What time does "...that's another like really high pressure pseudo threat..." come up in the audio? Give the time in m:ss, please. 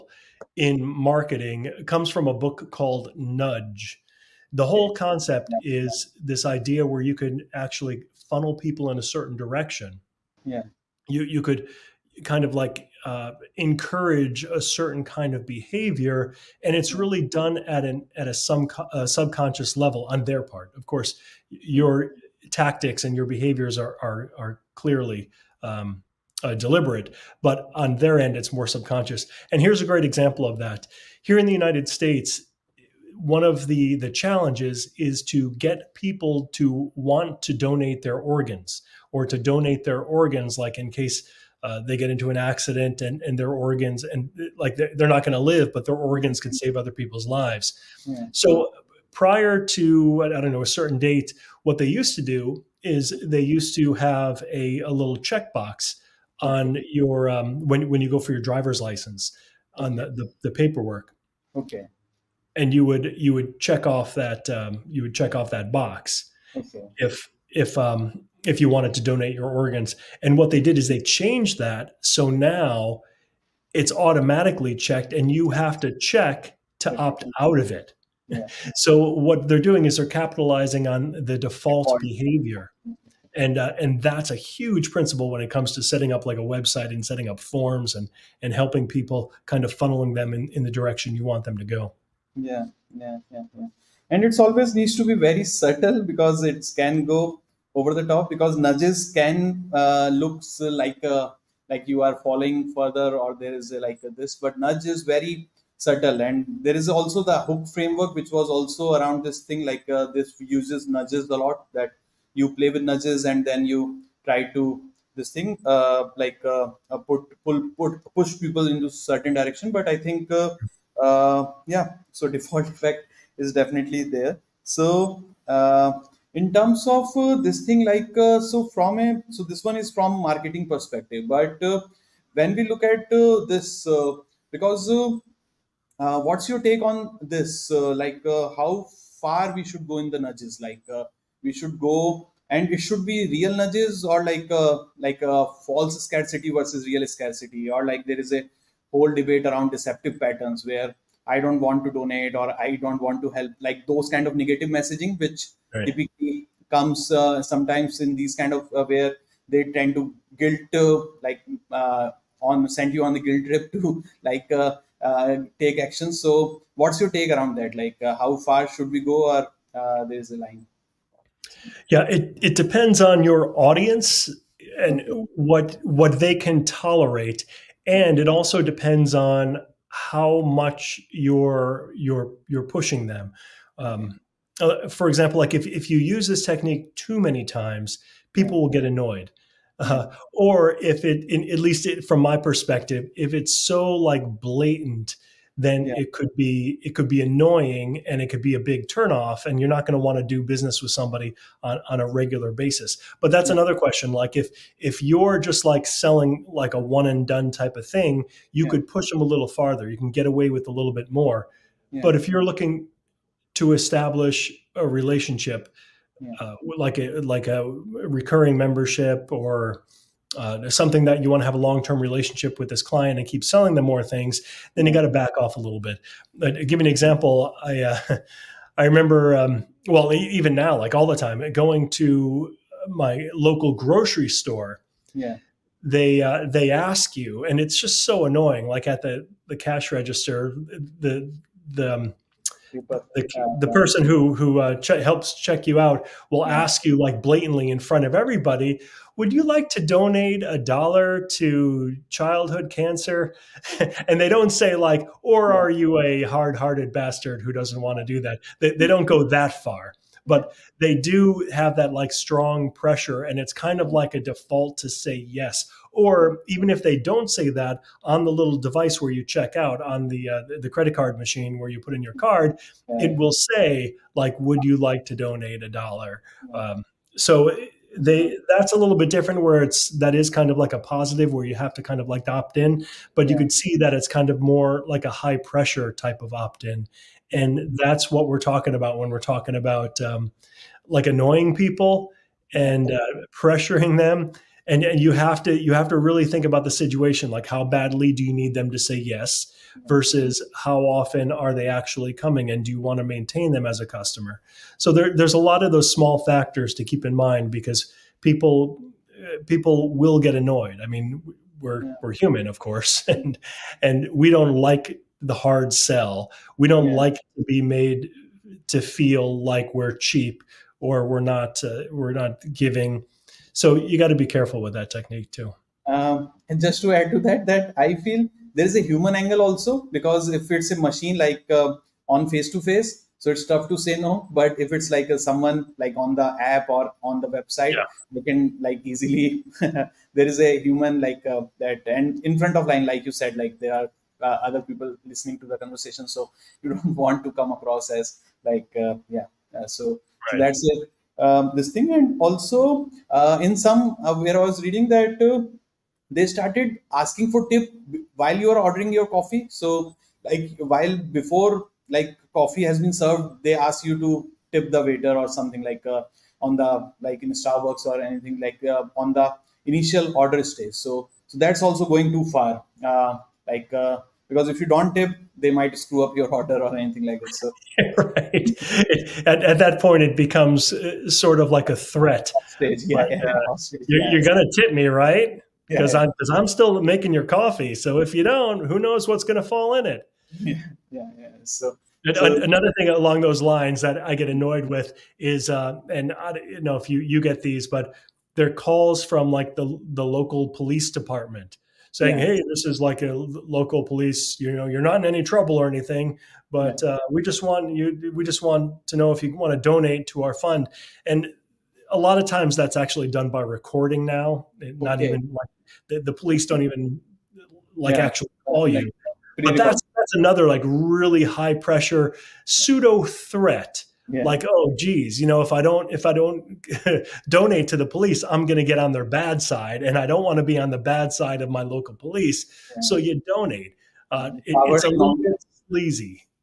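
6:59.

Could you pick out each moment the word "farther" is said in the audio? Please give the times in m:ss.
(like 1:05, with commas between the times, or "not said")
3:29.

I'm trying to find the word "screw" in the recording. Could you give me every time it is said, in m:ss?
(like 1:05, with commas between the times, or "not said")
6:15.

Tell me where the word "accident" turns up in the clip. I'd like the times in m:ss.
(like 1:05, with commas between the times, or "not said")
0:42.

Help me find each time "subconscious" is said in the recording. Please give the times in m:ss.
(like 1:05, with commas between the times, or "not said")
0:19, 0:28.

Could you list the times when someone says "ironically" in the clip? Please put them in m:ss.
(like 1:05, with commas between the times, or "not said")
not said.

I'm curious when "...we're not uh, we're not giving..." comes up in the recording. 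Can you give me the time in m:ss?
5:21.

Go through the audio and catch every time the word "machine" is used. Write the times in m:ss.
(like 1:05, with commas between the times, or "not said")
4:31, 5:30.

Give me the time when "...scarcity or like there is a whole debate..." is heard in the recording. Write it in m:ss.
2:27.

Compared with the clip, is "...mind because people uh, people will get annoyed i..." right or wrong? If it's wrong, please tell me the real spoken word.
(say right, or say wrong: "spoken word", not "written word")
right.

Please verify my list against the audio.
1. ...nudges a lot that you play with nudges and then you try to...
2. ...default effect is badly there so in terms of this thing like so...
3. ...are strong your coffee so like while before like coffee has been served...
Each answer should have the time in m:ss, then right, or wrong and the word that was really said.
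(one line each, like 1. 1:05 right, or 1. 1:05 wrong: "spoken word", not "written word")
1. 1:50 right
2. 2:02 wrong: "definitely", not "badly"
3. 5:58 wrong: "ordering", not "strong".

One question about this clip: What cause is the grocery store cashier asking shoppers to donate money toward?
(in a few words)
childhood cancer.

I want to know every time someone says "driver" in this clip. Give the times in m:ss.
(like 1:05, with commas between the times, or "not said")
0:58.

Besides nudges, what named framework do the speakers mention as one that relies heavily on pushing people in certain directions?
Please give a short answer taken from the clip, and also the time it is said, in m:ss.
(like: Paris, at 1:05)
hook framework, at 1:47.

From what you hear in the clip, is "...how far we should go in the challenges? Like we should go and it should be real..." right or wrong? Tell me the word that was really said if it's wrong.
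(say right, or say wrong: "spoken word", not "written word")
wrong: "nudges", not "challenges".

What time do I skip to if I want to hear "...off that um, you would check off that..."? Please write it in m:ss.
1:03.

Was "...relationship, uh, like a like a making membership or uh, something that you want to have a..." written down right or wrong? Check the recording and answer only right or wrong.
wrong.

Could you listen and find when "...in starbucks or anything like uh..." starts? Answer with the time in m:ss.
6:07.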